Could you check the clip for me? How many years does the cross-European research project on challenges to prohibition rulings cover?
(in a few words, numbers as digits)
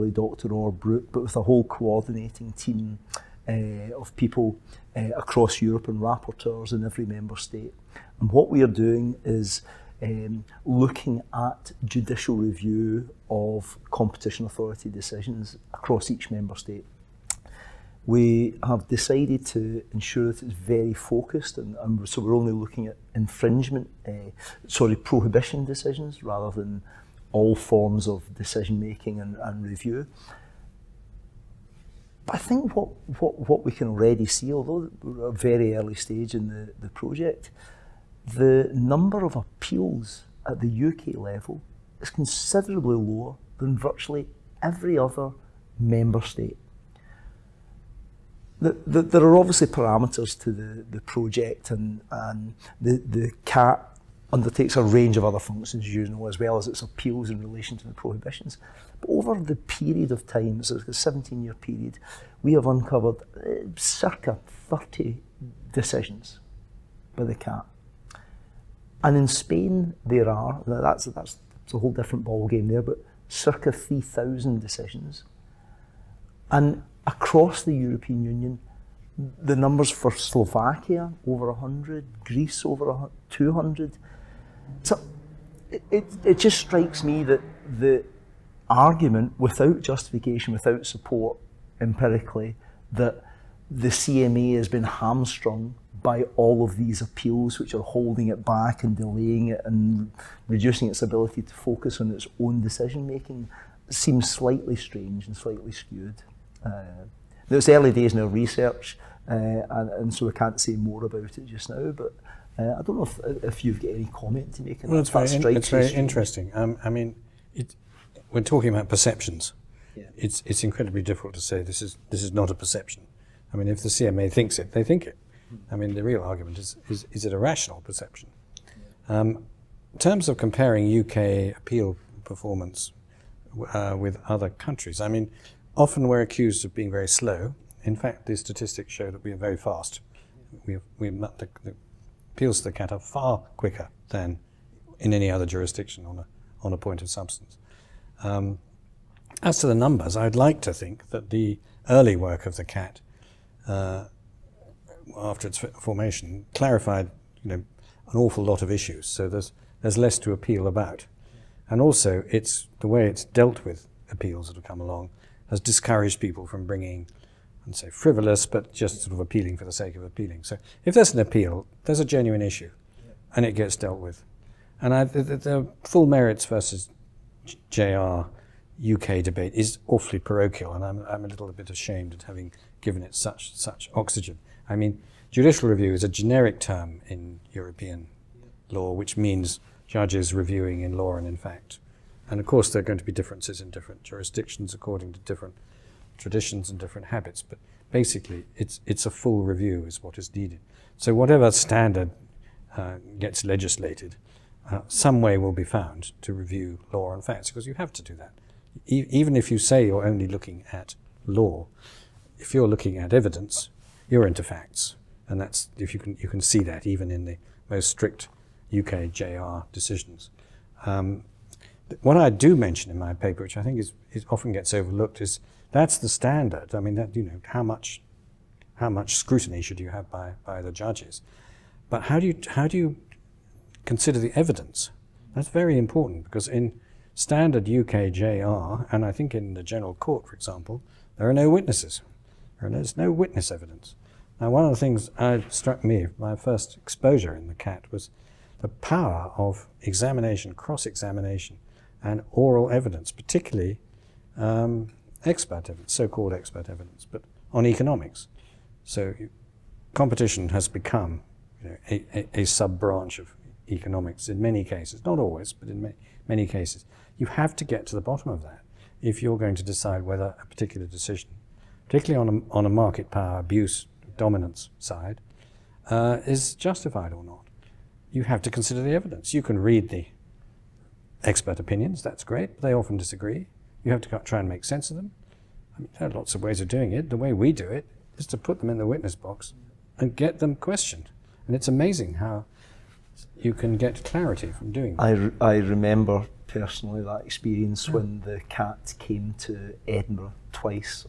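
17 years.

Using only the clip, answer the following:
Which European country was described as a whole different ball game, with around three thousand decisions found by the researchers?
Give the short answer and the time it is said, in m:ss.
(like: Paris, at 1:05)
Spain, at 1:09.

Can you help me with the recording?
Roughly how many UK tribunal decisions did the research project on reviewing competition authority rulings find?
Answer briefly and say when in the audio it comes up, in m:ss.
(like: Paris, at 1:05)
30, at 1:03.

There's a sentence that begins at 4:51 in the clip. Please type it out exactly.
And it's amazing how you can get clarity from doing that.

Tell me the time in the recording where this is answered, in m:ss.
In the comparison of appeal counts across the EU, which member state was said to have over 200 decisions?
1:22.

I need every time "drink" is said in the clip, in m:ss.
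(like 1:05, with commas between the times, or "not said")
not said.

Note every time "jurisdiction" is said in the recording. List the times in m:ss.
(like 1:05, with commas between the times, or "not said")
2:25, 3:14.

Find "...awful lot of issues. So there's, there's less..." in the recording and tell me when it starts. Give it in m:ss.
2:38.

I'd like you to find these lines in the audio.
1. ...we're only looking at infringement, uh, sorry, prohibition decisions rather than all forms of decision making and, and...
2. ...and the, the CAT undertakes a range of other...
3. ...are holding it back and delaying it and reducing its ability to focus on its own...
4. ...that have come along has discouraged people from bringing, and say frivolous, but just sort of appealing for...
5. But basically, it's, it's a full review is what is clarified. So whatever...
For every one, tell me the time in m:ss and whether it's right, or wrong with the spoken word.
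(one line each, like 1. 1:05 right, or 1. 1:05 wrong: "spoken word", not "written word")
1. 0:22 right
2. 0:52 right
3. 1:37 right
4. 2:44 right
5. 3:17 wrong: "needed", not "clarified".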